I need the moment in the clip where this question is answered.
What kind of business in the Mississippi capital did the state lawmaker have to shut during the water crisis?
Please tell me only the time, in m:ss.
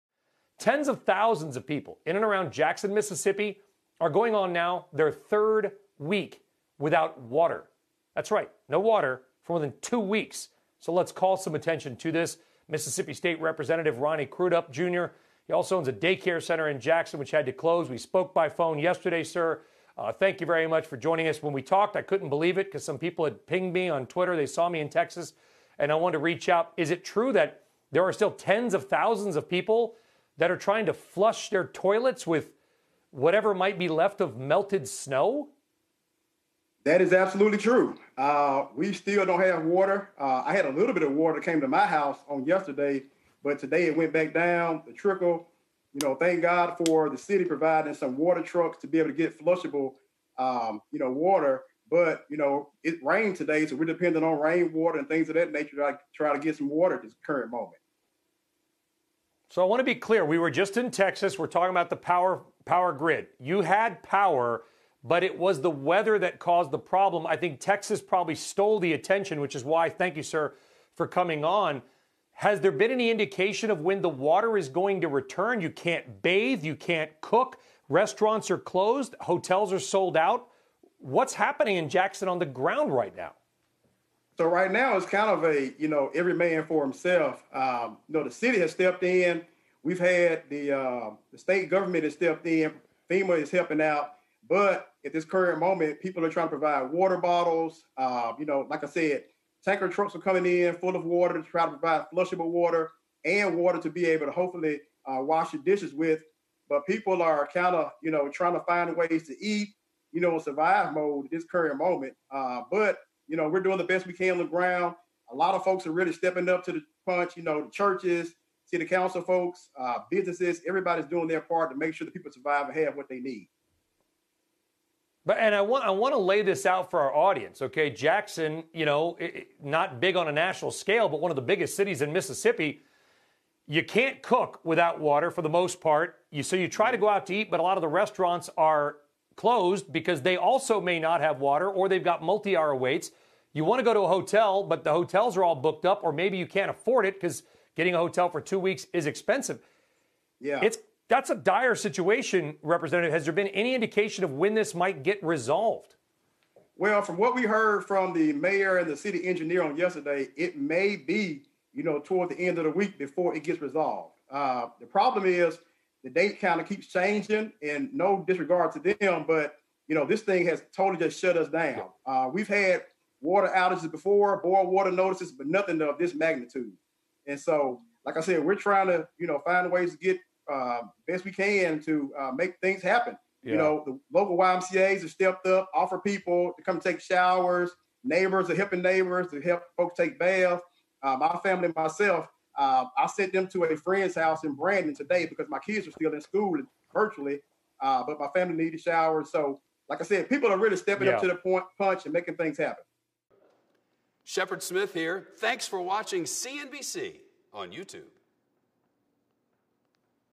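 0:15.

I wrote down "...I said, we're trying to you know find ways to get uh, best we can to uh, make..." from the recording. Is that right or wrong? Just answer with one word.
right.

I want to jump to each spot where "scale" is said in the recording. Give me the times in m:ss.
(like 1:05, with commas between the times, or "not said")
2:10.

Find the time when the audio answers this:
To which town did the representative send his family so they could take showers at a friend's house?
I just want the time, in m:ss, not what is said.
3:14.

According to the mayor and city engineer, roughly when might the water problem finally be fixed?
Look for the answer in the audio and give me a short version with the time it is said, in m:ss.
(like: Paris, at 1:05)
end of the week, at 2:42.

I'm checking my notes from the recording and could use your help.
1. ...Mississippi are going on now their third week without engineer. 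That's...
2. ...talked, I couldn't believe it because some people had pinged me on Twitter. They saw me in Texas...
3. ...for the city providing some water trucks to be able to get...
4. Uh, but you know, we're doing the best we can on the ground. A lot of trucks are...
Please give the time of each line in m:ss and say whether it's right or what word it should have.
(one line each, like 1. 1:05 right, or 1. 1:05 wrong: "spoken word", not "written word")
1. 0:02 wrong: "water", not "engineer"
2. 0:21 right
3. 0:46 right
4. 1:52 wrong: "folks", not "trucks".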